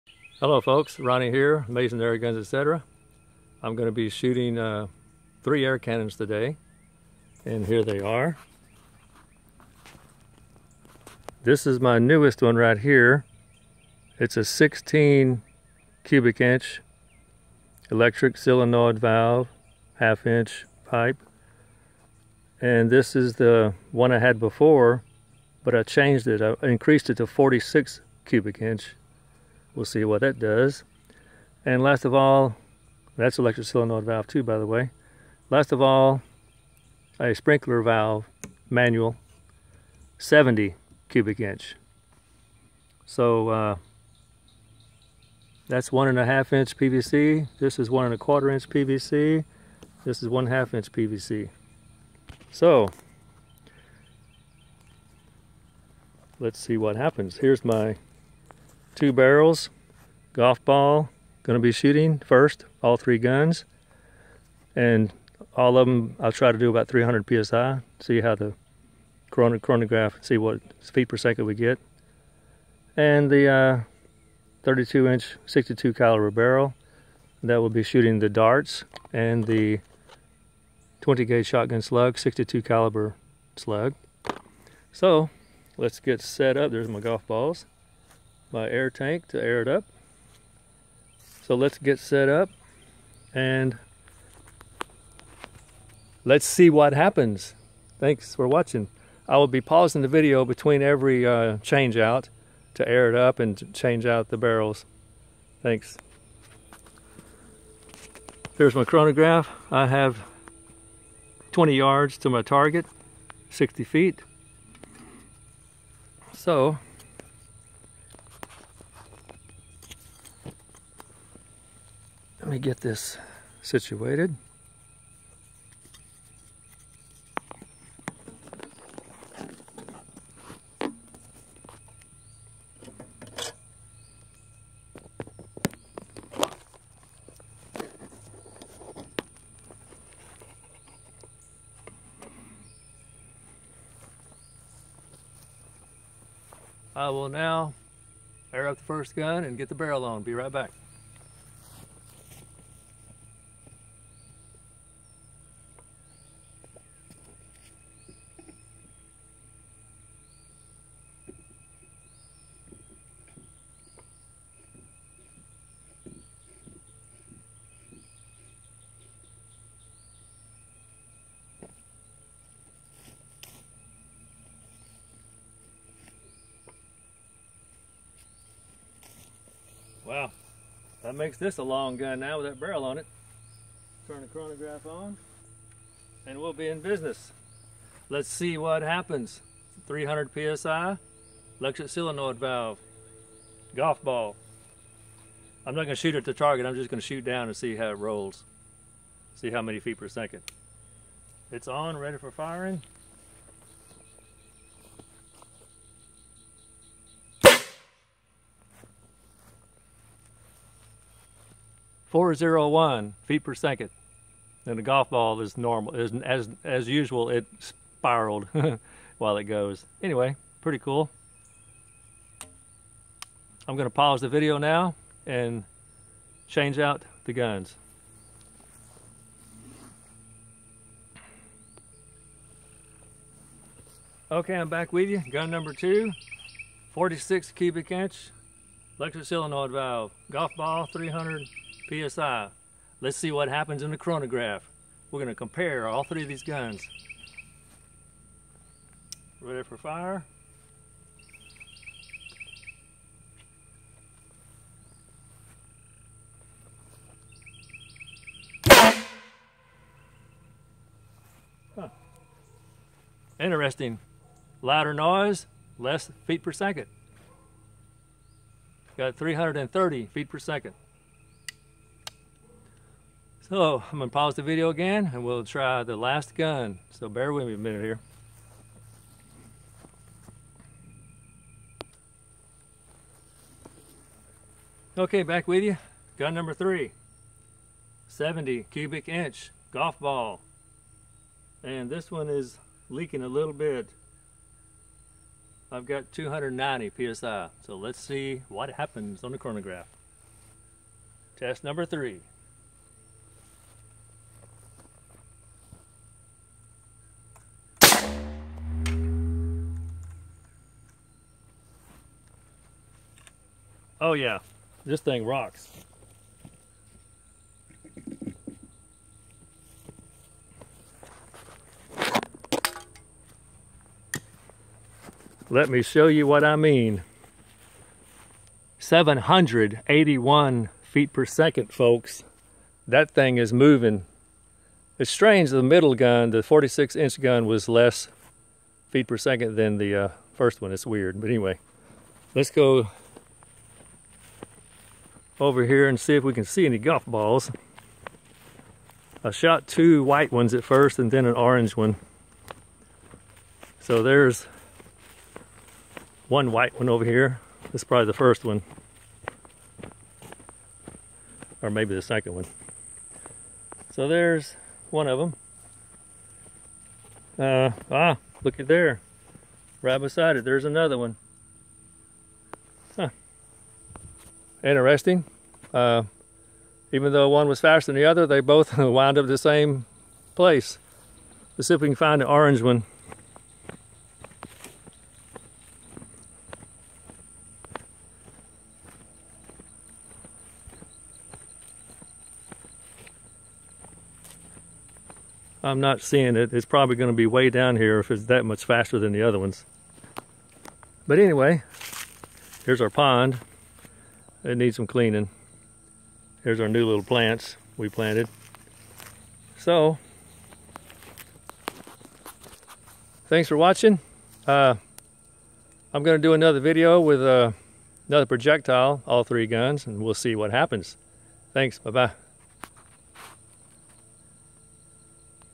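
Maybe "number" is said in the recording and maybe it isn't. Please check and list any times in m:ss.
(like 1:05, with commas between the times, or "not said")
3:55, 4:46, 5:01.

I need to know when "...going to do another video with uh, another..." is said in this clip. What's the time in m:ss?
6:56.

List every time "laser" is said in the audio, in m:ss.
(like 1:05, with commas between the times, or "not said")
not said.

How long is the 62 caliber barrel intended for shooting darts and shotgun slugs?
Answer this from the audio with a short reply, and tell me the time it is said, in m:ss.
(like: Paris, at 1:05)
32 inch, at 1:14.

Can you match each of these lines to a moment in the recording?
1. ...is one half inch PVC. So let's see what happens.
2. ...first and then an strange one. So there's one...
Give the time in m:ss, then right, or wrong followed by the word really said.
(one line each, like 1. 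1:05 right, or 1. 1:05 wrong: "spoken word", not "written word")
1. 0:50 right
2. 5:50 wrong: "orange", not "strange".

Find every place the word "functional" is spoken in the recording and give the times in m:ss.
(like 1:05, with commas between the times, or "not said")
not said.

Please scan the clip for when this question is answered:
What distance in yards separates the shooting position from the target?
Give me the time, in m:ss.
1:51.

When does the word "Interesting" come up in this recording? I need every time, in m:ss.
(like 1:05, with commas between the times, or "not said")
4:23, 6:14.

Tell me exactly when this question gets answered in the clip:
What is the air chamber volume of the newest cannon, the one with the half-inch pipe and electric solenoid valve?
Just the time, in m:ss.
0:14.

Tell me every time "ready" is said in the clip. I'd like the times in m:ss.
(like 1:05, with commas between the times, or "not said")
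3:21, 4:09.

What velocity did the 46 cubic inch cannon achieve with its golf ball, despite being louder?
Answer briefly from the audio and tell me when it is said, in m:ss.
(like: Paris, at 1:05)
330 feet per second, at 4:29.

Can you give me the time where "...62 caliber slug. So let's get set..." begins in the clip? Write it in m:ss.
1:22.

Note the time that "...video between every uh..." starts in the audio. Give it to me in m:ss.
1:40.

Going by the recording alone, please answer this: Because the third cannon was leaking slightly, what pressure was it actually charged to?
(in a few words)
290 PSI.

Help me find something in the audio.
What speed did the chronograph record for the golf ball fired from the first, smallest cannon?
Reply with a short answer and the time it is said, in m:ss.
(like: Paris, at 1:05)
401 feet per second, at 3:32.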